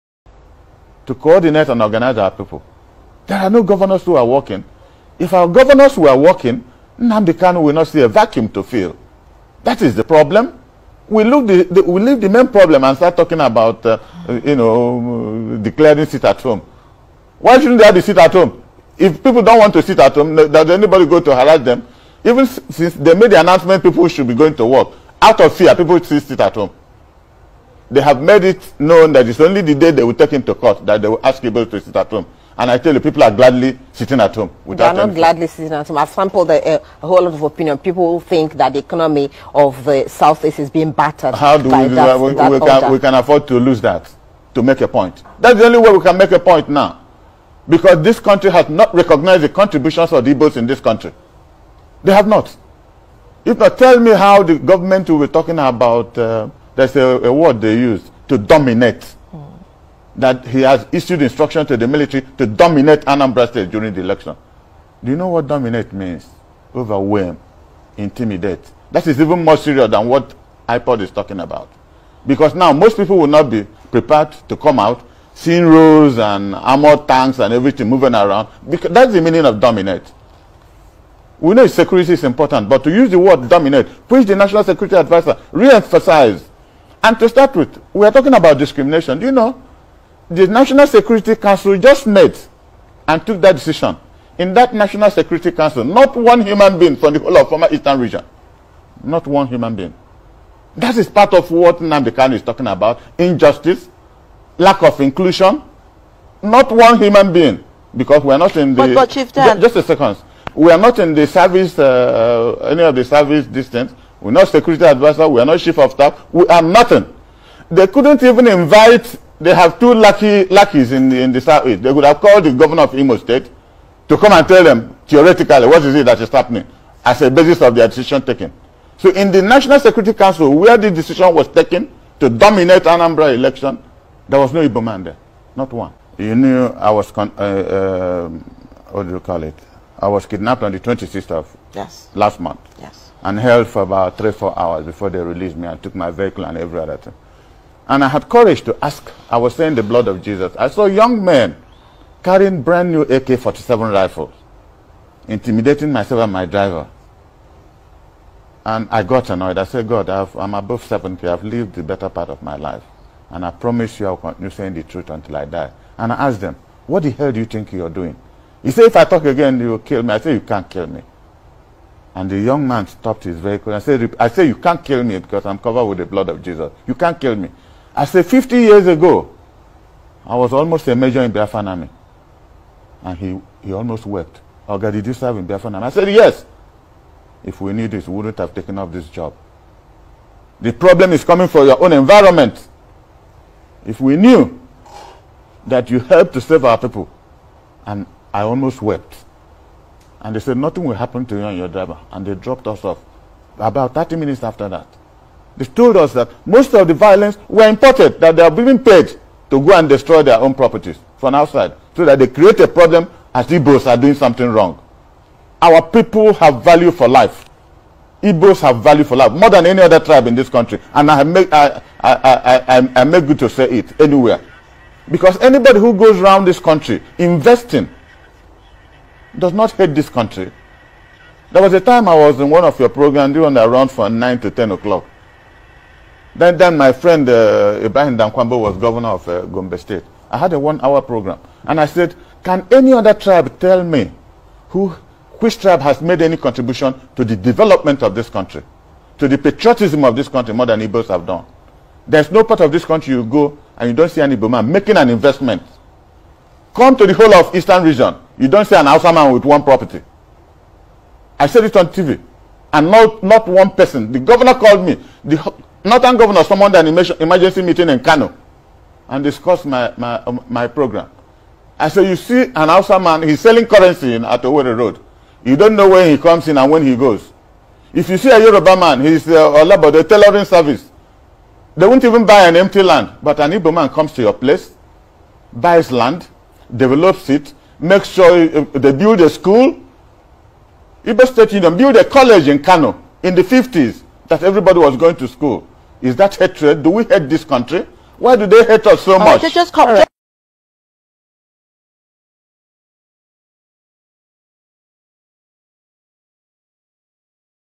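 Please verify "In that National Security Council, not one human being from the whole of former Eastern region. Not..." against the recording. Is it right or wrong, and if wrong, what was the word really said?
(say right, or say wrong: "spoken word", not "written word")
right.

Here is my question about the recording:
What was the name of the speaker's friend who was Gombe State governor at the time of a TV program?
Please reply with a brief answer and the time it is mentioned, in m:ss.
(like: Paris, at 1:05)
Ibrahim Dankwambo, at 3:57.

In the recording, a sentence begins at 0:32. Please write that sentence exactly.
And I tell you, people are gladly sitting at home.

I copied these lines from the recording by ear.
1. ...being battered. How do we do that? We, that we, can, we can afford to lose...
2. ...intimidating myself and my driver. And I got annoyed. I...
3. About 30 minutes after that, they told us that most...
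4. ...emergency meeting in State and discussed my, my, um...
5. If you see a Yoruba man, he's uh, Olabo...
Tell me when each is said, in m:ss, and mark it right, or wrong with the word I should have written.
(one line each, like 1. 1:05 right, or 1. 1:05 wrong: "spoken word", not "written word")
1. 0:40 right
2. 2:35 right
3. 3:23 right
4. 4:26 wrong: "Kano", not "State"
5. 4:37 right.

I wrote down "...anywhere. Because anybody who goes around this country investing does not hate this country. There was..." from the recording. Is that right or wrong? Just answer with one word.
right.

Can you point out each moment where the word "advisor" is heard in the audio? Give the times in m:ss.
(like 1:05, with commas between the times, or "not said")
1:24, 1:54.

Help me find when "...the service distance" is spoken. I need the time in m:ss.
1:52.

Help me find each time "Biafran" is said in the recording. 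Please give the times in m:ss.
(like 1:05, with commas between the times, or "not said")
3:01, 3:05.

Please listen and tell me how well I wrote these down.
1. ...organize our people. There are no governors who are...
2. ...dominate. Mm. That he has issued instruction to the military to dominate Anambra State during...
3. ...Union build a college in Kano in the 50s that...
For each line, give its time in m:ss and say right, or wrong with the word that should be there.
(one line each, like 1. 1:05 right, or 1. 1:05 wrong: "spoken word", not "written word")
1. 0:01 right
2. 0:58 right
3. 4:51 right.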